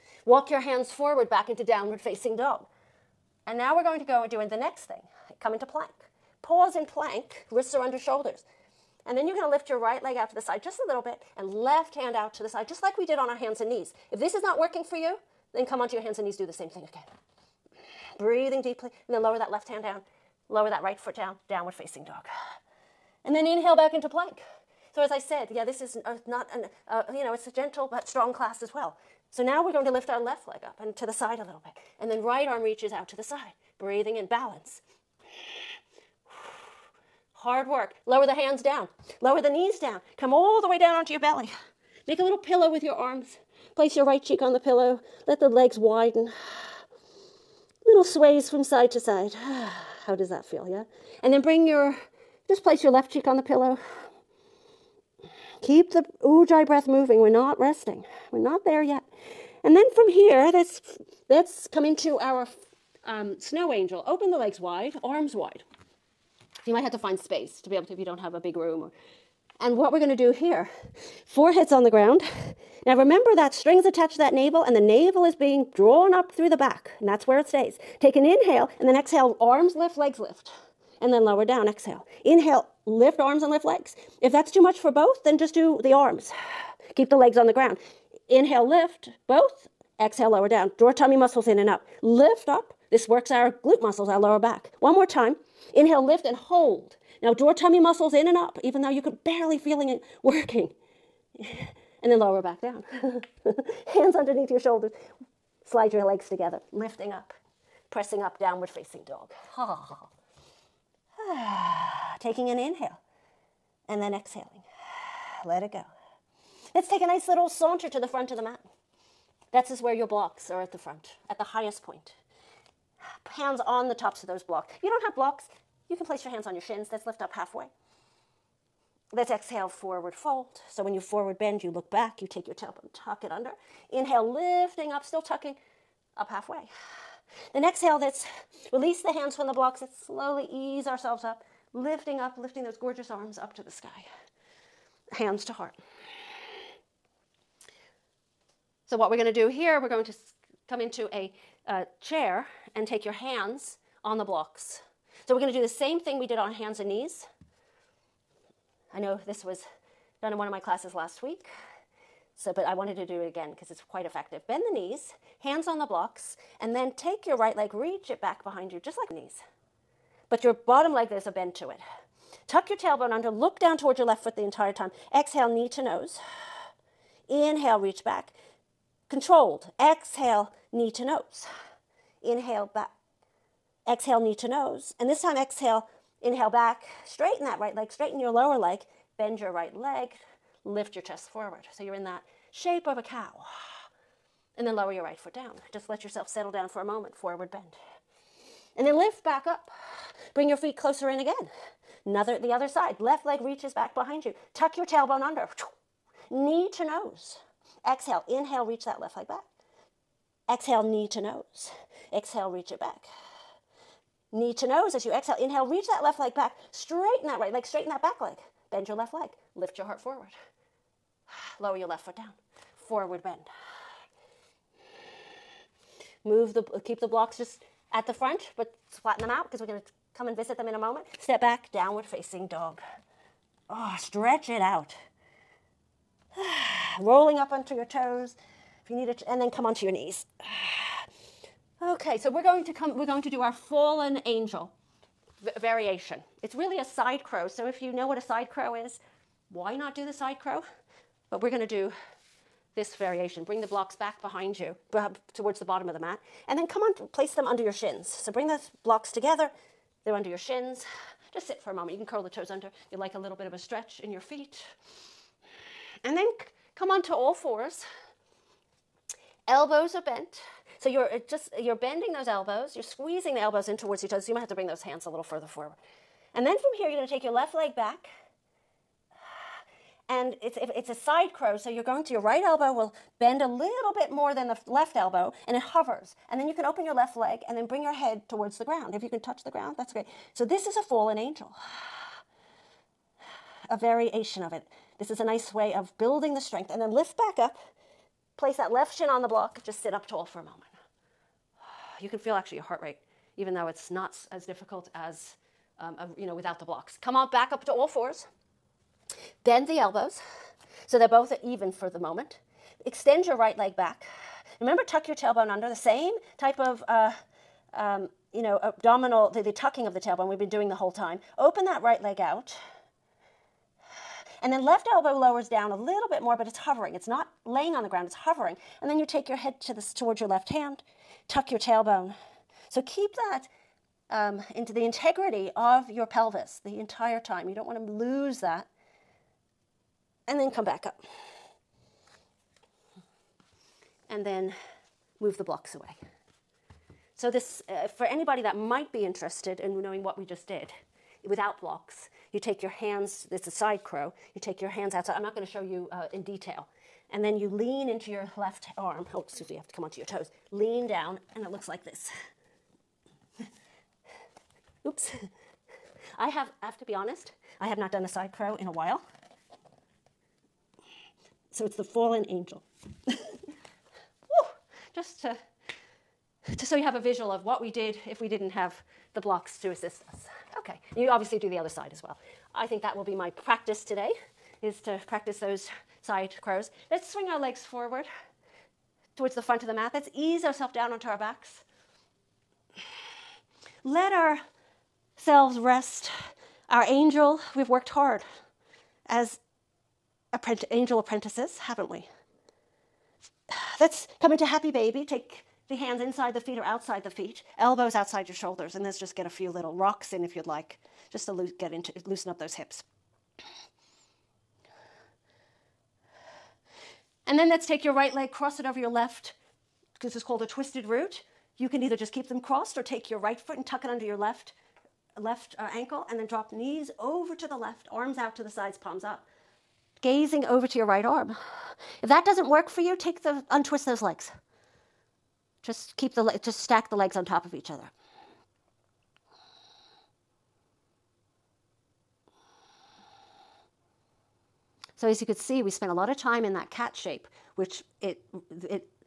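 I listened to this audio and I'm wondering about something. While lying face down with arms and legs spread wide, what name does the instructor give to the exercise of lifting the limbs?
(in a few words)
snow angel.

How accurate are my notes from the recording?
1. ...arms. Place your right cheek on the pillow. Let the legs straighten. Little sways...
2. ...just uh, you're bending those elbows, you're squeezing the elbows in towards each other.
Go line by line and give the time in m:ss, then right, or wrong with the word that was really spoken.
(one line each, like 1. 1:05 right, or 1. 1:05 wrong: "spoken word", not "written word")
1. 0:42 wrong: "widen", not "straighten"
2. 4:31 right.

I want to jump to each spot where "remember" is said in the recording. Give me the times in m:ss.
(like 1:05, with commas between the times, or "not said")
1:12, 5:14.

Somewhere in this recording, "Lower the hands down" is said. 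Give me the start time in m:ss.
0:38.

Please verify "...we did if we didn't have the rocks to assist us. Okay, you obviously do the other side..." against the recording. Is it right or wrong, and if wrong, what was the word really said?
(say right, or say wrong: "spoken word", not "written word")
wrong: "blocks", not "rocks".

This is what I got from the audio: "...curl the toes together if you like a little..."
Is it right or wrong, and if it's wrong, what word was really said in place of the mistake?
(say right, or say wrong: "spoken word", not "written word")
wrong: "under", not "together".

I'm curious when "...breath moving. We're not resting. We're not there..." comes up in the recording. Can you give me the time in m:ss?
0:56.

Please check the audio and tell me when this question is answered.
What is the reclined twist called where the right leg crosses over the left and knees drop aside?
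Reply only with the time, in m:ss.
7:00.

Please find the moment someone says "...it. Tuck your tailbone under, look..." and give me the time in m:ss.
2:51.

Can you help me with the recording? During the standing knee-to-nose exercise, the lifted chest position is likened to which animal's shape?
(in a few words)
cow.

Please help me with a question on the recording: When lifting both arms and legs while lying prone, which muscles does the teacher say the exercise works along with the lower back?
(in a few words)
glute muscles.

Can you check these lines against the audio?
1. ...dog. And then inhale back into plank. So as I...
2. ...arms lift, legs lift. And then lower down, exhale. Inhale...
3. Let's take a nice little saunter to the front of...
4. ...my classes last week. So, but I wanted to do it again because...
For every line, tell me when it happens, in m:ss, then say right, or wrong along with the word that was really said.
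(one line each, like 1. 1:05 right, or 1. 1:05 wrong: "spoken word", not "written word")
1. 0:22 right
2. 1:19 right
3. 1:56 right
4. 2:40 right.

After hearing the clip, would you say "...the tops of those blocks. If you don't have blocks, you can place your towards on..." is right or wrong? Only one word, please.
wrong.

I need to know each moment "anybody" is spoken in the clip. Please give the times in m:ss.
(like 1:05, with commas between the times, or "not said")
5:48.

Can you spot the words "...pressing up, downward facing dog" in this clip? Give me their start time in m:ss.
1:47.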